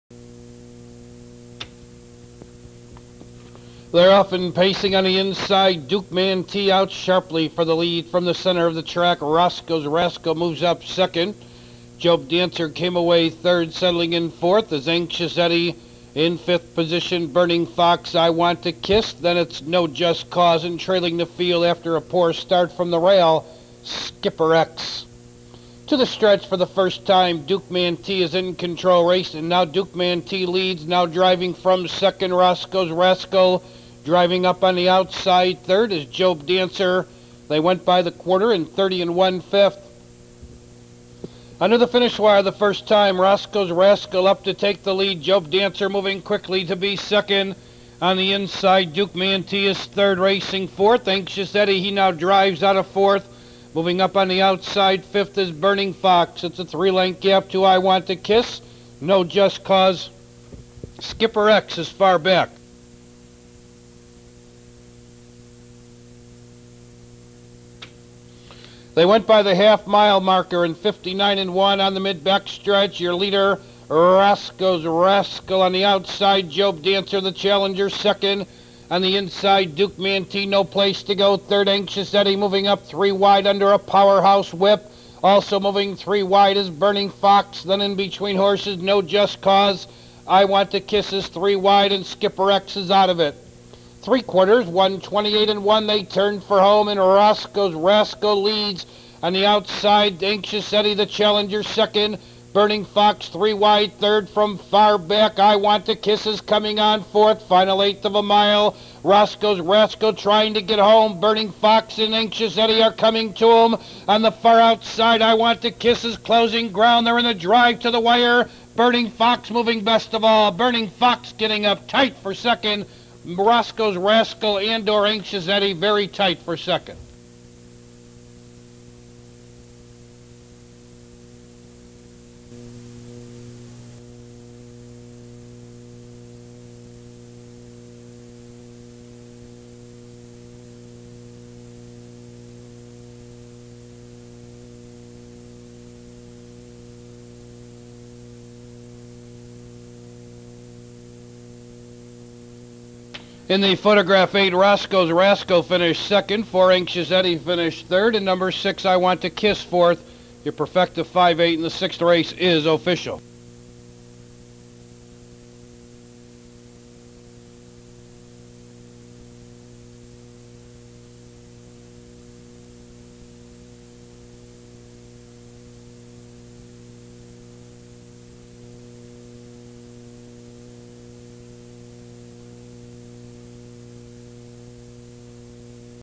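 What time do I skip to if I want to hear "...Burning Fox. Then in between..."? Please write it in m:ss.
1:26.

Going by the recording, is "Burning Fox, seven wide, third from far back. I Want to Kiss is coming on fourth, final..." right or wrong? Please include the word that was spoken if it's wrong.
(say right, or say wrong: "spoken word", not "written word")
wrong: "three", not "seven".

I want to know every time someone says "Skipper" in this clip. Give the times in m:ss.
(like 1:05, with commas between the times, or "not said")
0:23, 1:00, 1:32.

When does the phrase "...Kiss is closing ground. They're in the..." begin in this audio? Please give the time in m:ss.
1:55.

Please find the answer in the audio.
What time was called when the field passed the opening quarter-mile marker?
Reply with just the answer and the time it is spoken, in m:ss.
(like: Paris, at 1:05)
30 1/5, at 0:38.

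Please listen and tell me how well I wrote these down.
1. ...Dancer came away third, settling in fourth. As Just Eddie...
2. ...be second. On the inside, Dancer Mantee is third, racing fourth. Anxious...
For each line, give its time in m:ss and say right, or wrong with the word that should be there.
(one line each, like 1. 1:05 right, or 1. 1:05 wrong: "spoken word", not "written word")
1. 0:12 wrong: "Anxious", not "Just"
2. 0:46 wrong: "Duke", not "Dancer".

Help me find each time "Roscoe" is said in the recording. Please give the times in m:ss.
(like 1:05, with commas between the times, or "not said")
0:09, 0:32, 0:43, 1:13, 1:36, 1:49, 2:03, 2:34.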